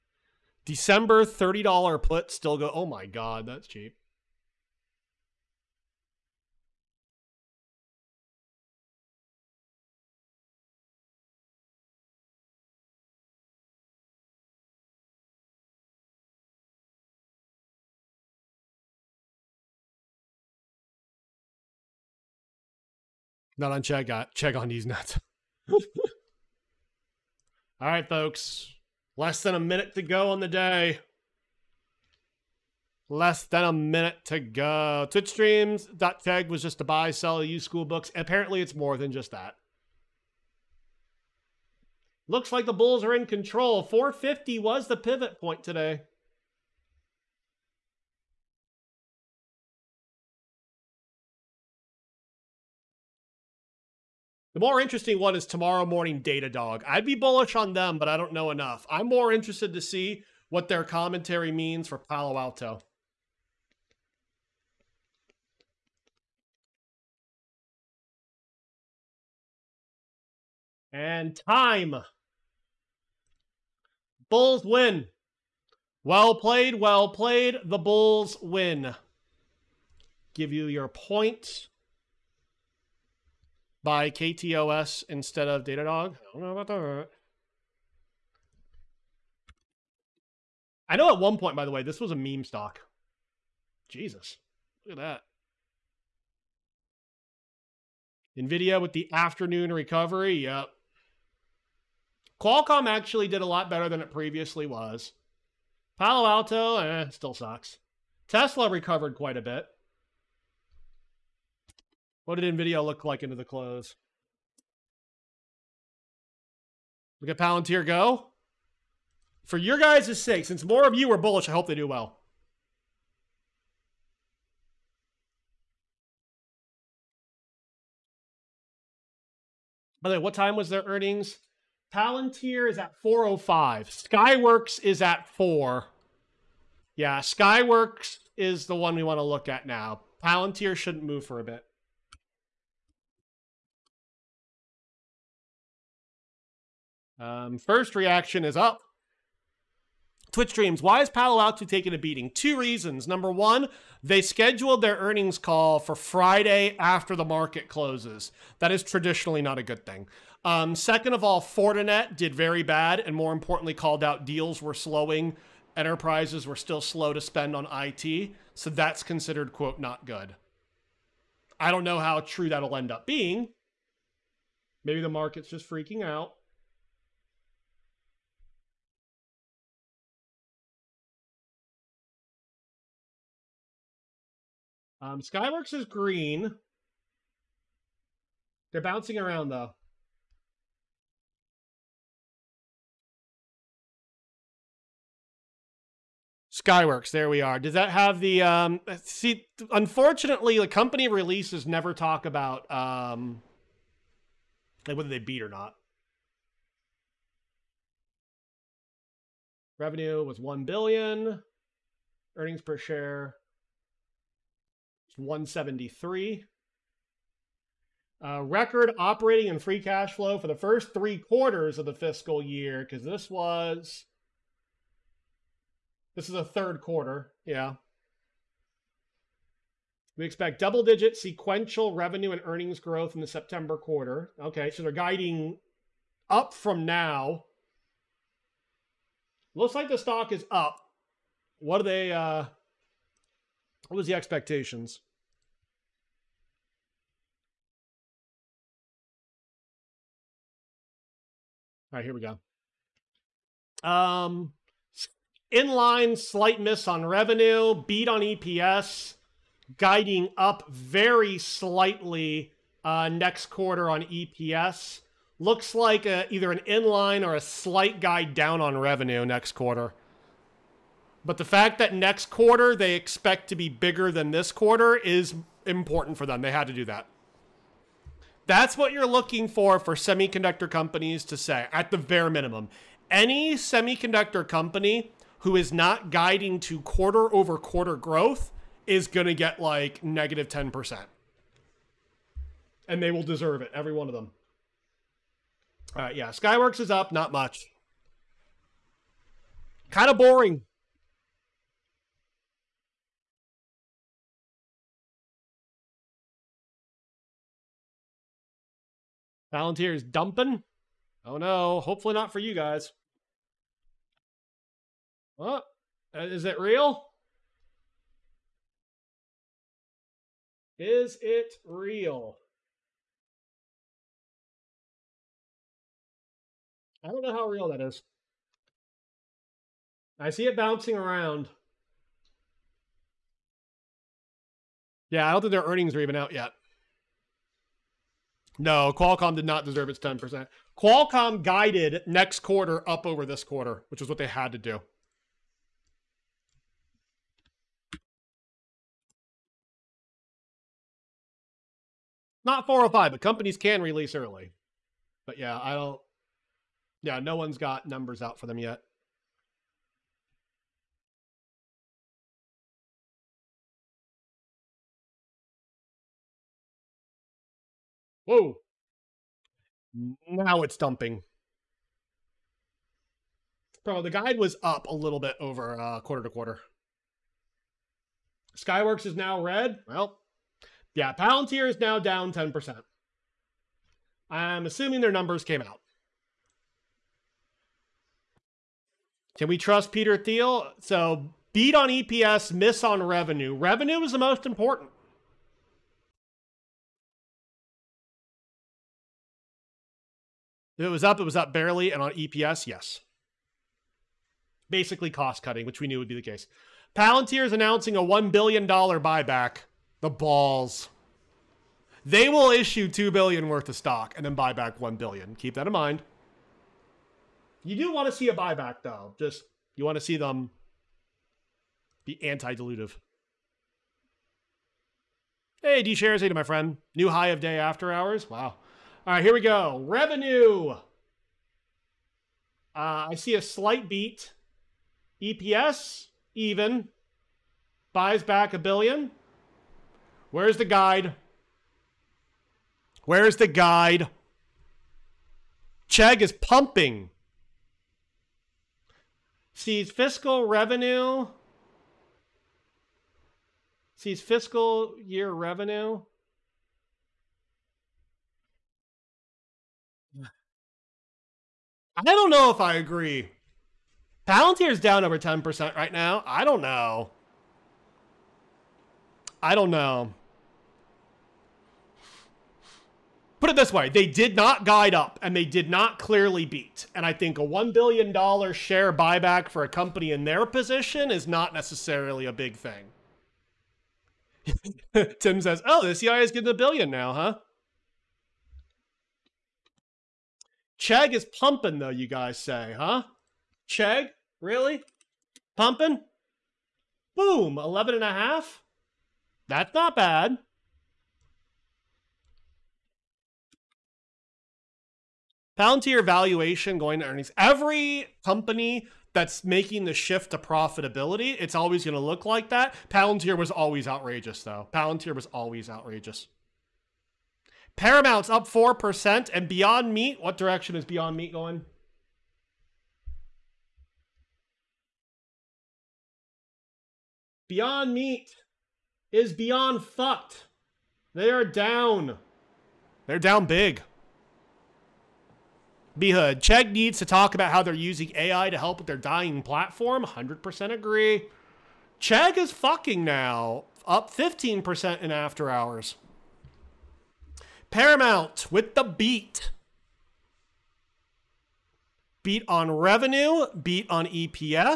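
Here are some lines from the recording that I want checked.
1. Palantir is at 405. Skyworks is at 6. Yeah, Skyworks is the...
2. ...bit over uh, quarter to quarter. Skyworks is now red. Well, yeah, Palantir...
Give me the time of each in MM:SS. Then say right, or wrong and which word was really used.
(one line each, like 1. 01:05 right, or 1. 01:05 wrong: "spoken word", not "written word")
1. 02:11 wrong: "4", not "6"
2. 06:15 right.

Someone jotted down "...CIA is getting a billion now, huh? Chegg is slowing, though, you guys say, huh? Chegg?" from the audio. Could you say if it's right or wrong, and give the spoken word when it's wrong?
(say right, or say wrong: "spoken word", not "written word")
wrong: "pumping", not "slowing".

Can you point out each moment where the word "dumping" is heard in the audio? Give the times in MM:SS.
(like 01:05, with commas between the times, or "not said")
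05:10, 06:10.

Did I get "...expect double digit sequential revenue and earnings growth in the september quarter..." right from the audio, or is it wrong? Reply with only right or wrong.
right.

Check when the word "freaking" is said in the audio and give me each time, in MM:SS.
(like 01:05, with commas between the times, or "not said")
02:55.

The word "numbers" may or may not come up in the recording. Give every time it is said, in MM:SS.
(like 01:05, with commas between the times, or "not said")
02:33, 05:57, 06:25.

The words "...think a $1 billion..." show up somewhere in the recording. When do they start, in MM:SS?
07:57.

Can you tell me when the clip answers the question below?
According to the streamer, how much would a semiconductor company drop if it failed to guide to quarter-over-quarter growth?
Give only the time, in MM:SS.
04:50.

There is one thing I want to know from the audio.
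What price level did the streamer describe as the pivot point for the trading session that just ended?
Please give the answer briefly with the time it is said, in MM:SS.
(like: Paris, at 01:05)
450, at 00:43.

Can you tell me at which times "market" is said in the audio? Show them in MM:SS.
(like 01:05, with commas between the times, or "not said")
02:37, 02:55.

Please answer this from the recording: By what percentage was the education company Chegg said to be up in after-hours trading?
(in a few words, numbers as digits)
15%.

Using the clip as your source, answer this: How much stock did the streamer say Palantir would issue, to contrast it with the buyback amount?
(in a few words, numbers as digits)
2 billion.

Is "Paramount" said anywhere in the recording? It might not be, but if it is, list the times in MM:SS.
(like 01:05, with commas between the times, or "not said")
08:37, 09:07.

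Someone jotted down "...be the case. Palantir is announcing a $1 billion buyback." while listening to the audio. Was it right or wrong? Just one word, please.
right.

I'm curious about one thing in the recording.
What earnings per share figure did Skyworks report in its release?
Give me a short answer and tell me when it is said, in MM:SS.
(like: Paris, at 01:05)
1.73, at 03:35.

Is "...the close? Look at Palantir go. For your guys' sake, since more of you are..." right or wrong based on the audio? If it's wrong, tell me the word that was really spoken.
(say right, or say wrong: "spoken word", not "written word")
right.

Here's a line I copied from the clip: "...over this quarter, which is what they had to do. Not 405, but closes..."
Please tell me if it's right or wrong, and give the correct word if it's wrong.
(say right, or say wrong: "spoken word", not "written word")
wrong: "companies", not "closes".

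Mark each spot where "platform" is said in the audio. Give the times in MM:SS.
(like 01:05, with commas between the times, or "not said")
08:59.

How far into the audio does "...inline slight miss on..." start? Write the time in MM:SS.
04:15.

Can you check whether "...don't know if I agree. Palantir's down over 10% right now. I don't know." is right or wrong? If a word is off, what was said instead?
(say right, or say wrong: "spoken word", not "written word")
right.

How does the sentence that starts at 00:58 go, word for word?
I'm more interested to see what their commentary means for Palo Alto.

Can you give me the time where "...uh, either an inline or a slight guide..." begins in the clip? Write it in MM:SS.
04:26.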